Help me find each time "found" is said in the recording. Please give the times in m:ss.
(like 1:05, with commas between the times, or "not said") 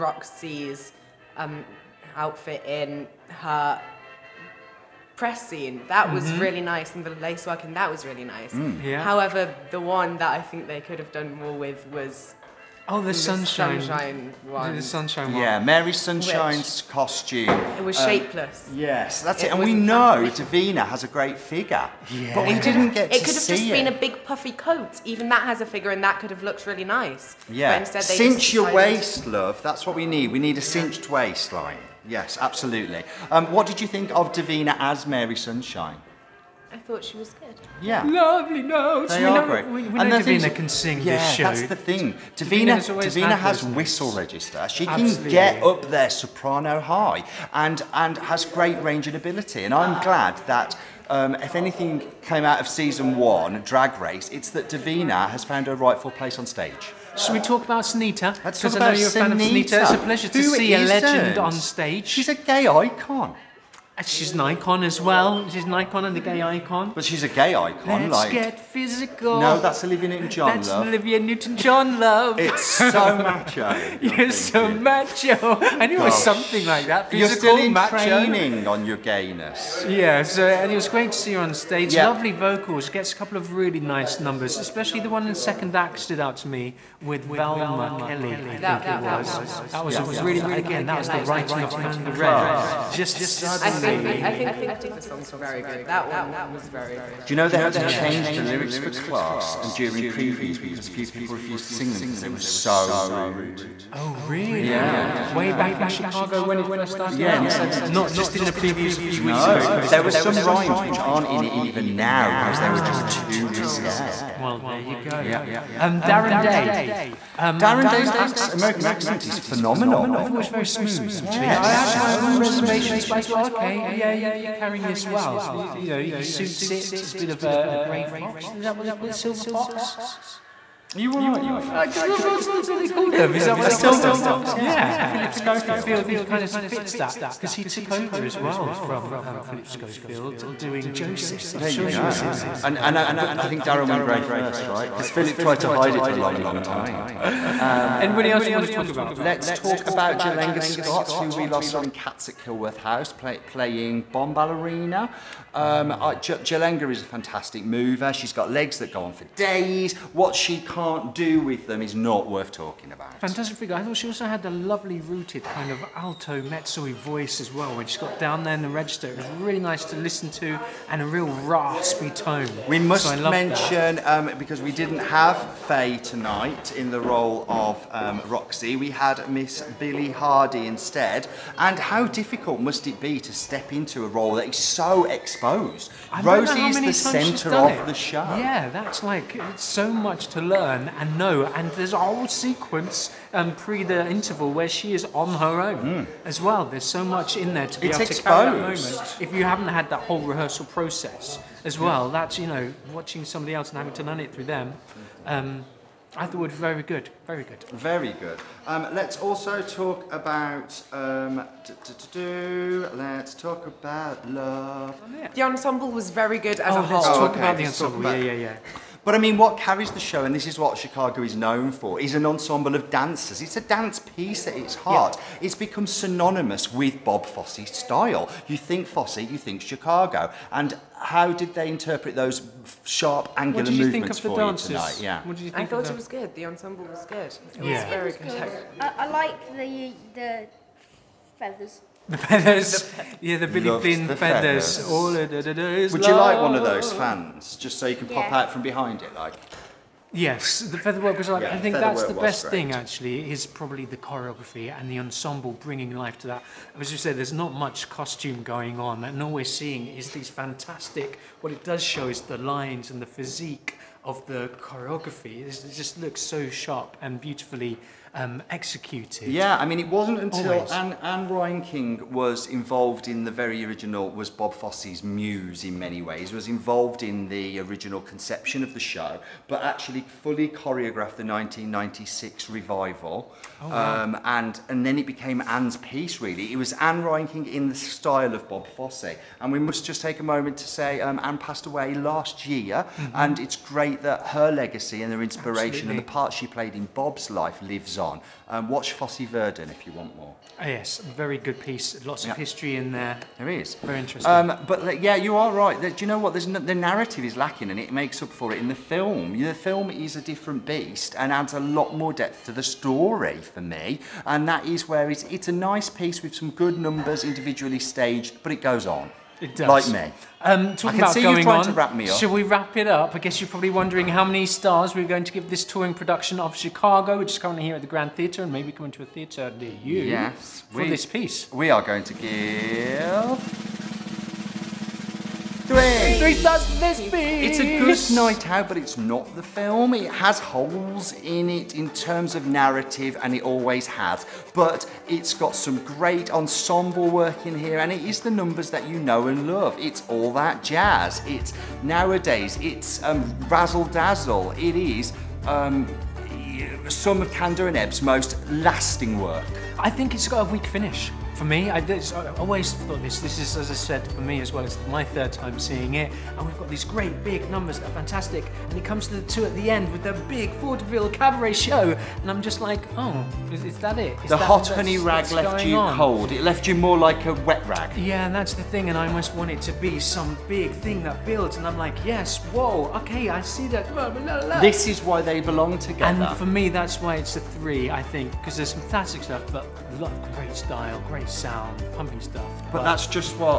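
0:55.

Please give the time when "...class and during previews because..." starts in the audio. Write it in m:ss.
1:38.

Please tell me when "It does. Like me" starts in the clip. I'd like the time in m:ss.
5:19.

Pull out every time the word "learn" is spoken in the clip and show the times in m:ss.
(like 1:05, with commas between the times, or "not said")
3:10, 3:24.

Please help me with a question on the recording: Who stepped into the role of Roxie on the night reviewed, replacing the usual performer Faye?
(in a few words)
Billy Hardy.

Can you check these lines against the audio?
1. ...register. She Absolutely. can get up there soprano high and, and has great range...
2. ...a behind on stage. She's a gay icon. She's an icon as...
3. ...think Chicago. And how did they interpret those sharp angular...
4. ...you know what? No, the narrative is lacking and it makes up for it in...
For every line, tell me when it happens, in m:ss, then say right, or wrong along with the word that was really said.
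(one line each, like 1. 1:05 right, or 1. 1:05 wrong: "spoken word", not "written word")
1. 0:44 right
2. 1:00 wrong: "legend", not "behind"
3. 3:49 right
4. 5:05 right.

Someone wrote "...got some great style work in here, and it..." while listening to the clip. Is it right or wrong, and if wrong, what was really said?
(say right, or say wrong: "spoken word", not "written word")
wrong: "ensemble", not "style".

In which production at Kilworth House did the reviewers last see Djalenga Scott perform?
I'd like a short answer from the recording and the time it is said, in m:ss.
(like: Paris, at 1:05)
Cats, at 2:31.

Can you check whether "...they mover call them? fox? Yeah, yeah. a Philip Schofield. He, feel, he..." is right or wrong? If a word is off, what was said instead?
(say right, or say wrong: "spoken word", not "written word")
wrong: "silver", not "mover".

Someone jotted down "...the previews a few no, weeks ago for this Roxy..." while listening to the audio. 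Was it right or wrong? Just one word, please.
wrong.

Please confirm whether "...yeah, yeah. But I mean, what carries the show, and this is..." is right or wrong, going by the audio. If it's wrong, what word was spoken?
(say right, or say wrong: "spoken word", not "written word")
right.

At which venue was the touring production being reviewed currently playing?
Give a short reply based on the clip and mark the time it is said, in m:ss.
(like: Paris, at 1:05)
The Grand Theatre, at 5:27.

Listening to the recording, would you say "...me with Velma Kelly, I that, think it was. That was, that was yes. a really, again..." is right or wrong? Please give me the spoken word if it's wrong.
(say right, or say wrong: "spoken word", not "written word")
right.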